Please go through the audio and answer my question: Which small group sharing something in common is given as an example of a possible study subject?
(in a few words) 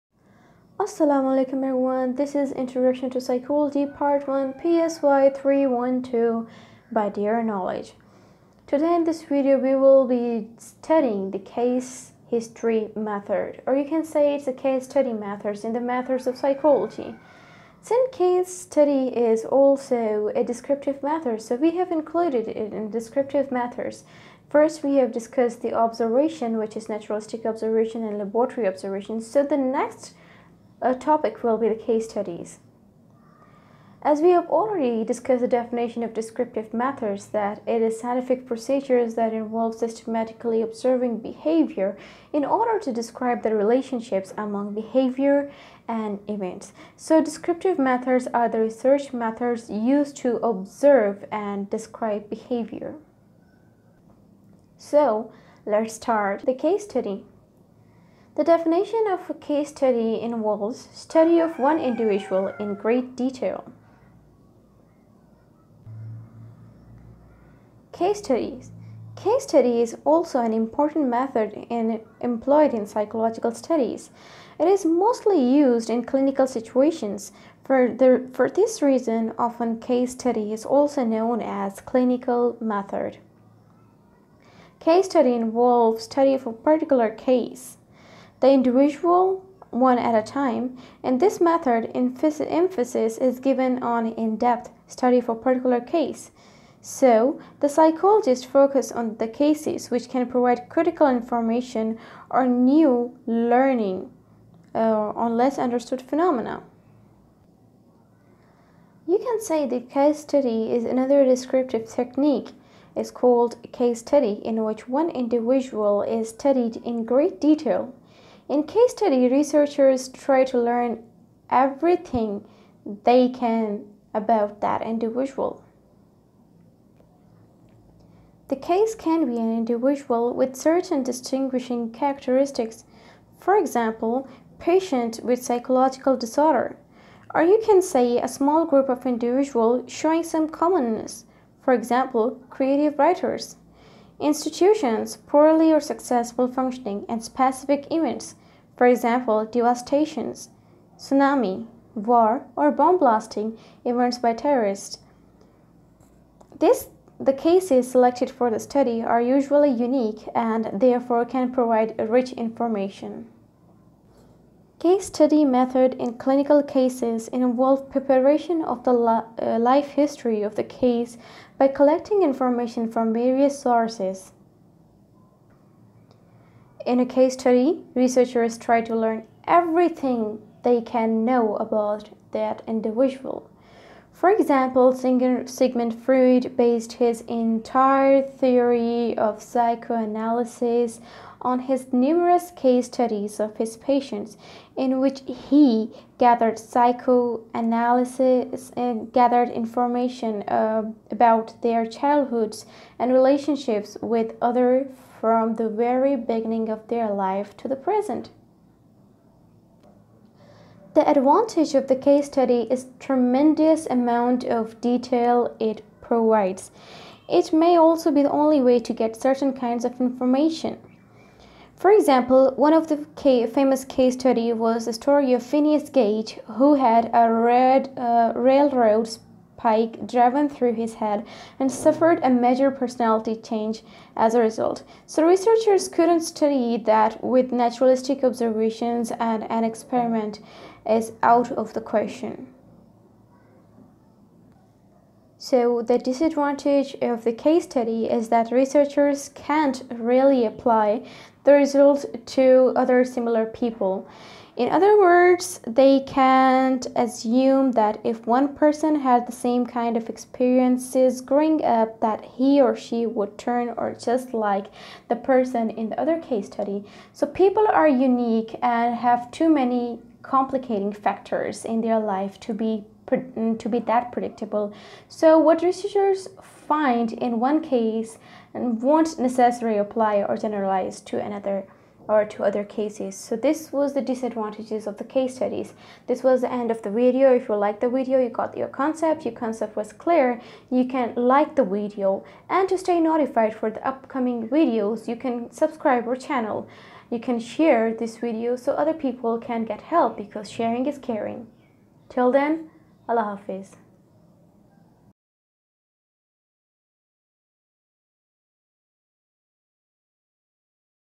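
creative writers.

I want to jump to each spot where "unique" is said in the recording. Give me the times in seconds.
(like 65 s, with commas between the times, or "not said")
159 s, 267 s.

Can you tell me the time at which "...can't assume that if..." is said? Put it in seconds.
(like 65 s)
256 s.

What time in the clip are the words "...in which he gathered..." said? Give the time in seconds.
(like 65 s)
194 s.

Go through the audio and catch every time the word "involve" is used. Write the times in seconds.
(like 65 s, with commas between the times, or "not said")
39 s, 60 s, 85 s, 167 s.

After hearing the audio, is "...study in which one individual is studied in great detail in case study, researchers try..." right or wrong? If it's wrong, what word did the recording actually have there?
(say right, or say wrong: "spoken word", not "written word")
right.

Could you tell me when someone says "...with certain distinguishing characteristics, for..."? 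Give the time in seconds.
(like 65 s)
130 s.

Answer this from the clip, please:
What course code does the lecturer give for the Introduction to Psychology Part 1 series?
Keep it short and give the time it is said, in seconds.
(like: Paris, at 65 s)
PSY 312, at 4 s.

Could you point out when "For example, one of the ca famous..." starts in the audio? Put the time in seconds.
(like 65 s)
221 s.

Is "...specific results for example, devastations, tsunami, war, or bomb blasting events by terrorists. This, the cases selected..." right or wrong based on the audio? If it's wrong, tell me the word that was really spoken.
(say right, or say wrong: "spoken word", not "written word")
wrong: "events", not "results".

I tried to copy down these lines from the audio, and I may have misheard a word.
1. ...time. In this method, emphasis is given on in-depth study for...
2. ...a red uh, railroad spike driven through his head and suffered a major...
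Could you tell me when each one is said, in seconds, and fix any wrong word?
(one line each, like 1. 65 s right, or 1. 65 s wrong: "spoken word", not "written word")
1. 90 s right
2. 227 s right.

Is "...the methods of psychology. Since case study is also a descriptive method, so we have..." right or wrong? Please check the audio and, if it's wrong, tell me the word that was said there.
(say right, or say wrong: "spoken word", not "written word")
right.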